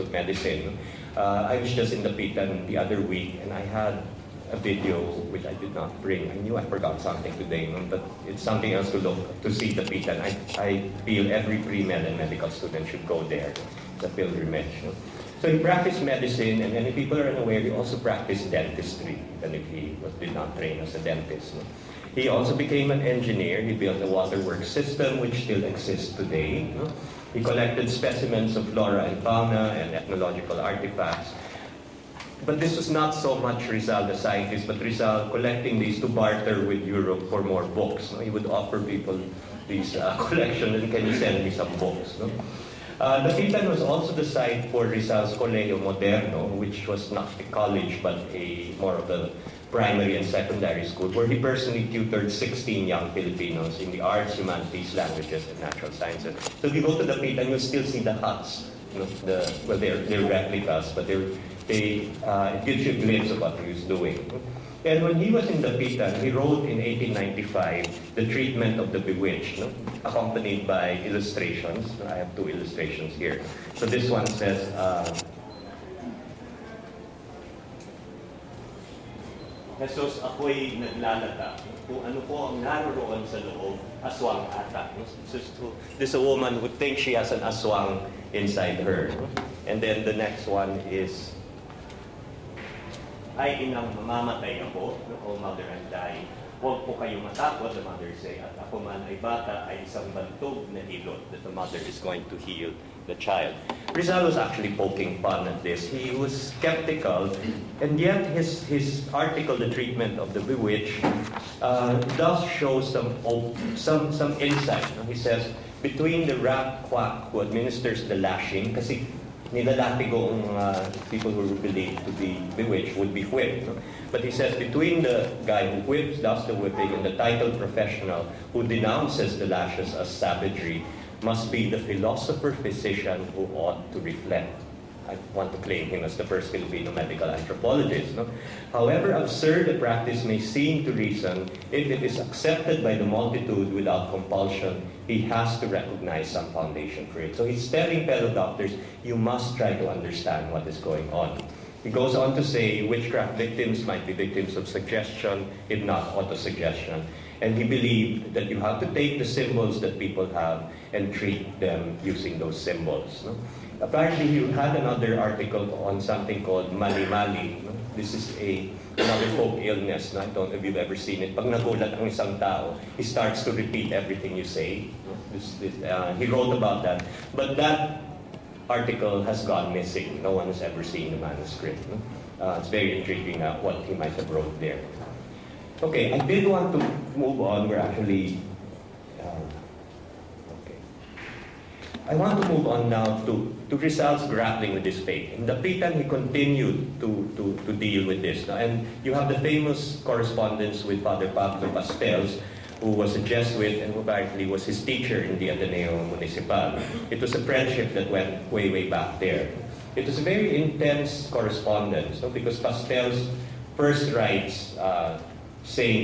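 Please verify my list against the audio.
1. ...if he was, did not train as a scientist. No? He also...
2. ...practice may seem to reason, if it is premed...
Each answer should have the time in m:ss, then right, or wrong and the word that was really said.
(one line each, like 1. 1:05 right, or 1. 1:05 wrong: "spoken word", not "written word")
1. 0:19 wrong: "dentist", not "scientist"
2. 2:19 wrong: "accepted", not "premed".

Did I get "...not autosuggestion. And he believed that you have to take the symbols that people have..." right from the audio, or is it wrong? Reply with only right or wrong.
right.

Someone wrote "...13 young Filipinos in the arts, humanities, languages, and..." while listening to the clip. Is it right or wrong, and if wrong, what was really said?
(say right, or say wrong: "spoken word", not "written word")
wrong: "16", not "13".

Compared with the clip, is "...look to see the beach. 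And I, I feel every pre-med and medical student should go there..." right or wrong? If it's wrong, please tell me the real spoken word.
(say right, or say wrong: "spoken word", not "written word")
right.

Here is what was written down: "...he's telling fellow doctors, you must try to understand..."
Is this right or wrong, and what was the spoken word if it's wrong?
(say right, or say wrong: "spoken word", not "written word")
right.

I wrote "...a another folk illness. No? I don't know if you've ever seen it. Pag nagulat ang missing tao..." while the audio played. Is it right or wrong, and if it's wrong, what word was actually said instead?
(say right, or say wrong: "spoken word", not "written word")
wrong: "isang", not "missing".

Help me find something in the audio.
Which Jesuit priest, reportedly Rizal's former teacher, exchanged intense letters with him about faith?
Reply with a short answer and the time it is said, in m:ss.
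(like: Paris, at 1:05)
Pablo Pastels, at 3:21.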